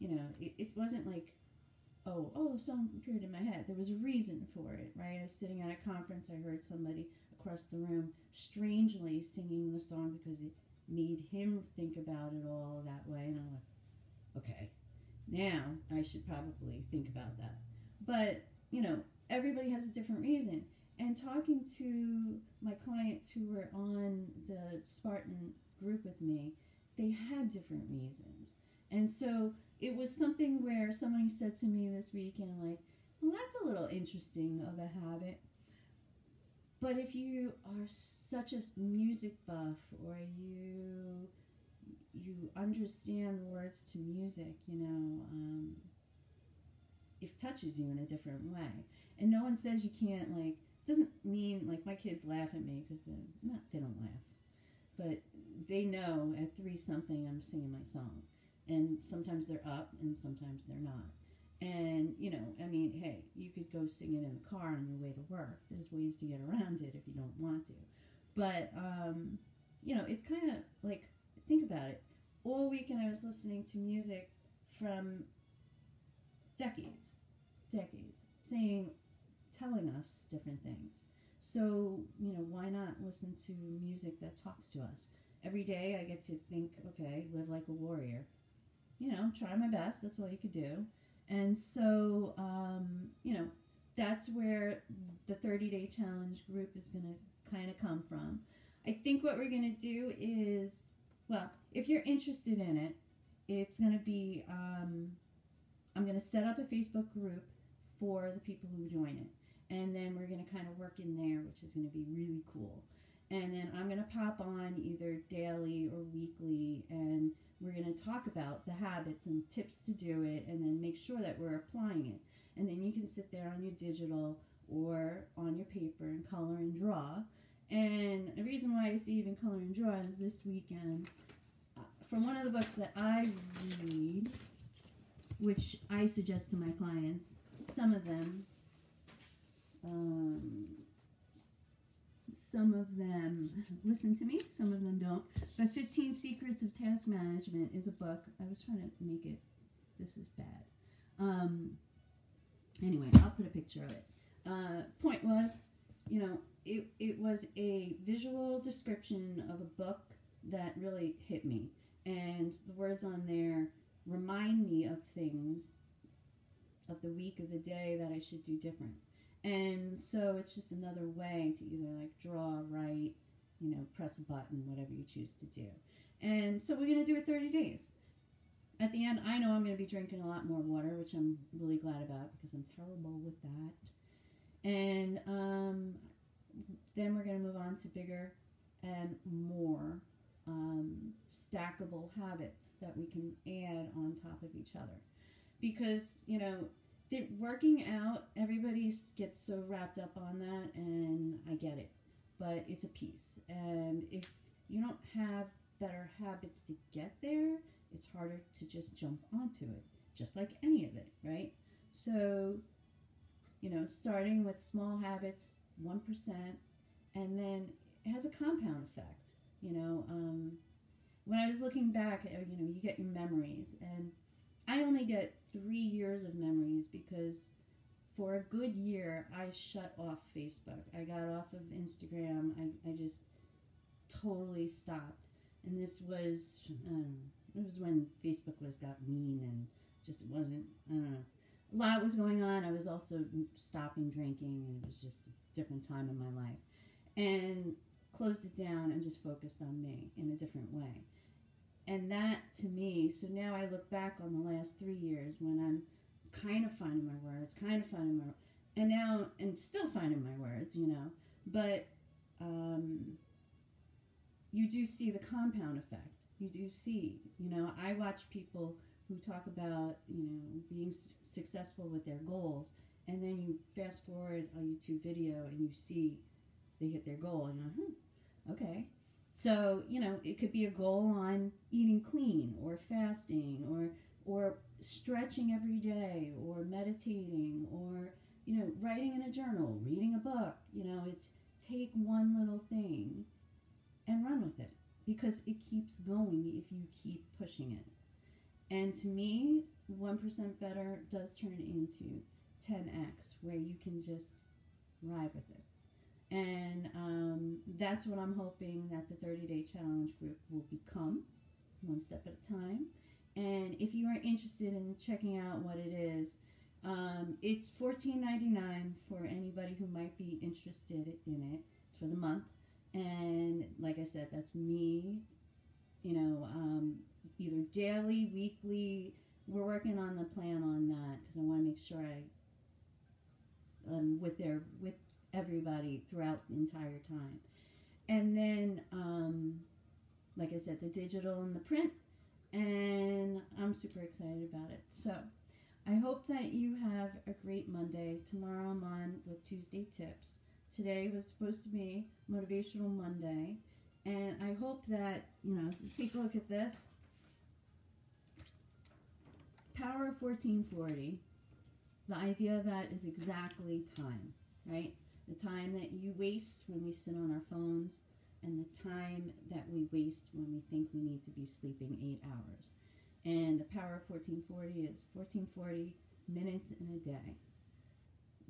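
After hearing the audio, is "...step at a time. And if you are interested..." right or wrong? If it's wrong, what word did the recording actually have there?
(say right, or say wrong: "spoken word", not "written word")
right.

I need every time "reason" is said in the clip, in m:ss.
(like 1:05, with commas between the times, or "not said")
0:03, 0:20, 0:27, 2:08.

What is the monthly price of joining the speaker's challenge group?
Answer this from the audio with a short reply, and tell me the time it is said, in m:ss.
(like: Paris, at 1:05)
$14.99, at 5:17.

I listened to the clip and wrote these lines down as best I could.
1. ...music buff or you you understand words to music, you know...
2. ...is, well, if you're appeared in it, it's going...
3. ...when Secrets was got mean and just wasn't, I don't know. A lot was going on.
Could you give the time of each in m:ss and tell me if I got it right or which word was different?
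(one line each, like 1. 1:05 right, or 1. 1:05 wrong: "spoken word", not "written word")
1. 0:38 right
2. 1:40 wrong: "interested", not "appeared"
3. 3:57 wrong: "Facebook", not "Secrets".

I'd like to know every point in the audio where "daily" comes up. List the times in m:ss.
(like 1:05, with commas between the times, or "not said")
1:55, 5:27.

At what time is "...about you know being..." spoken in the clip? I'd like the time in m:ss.
4:29.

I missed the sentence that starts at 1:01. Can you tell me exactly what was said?
And, you know, I mean, hey, you could go sing it in the car on your way to work.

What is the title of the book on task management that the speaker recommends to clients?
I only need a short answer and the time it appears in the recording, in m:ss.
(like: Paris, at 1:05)
15 Secrets of Task Management, at 2:25.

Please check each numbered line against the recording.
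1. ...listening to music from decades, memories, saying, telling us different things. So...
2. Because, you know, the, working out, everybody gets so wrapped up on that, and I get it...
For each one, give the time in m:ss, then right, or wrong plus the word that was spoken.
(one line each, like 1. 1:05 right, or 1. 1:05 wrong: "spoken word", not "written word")
1. 1:13 wrong: "decades", not "memories"
2. 3:15 right.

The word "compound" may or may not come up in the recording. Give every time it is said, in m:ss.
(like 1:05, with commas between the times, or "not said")
3:38, 4:25.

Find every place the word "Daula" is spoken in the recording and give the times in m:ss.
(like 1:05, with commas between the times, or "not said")
not said.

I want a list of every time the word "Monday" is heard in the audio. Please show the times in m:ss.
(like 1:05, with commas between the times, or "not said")
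5:47, 5:52.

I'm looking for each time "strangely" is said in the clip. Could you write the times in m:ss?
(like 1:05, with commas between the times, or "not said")
0:08.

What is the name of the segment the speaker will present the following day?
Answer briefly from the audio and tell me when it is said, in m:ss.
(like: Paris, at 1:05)
Tuesday Tips, at 5:49.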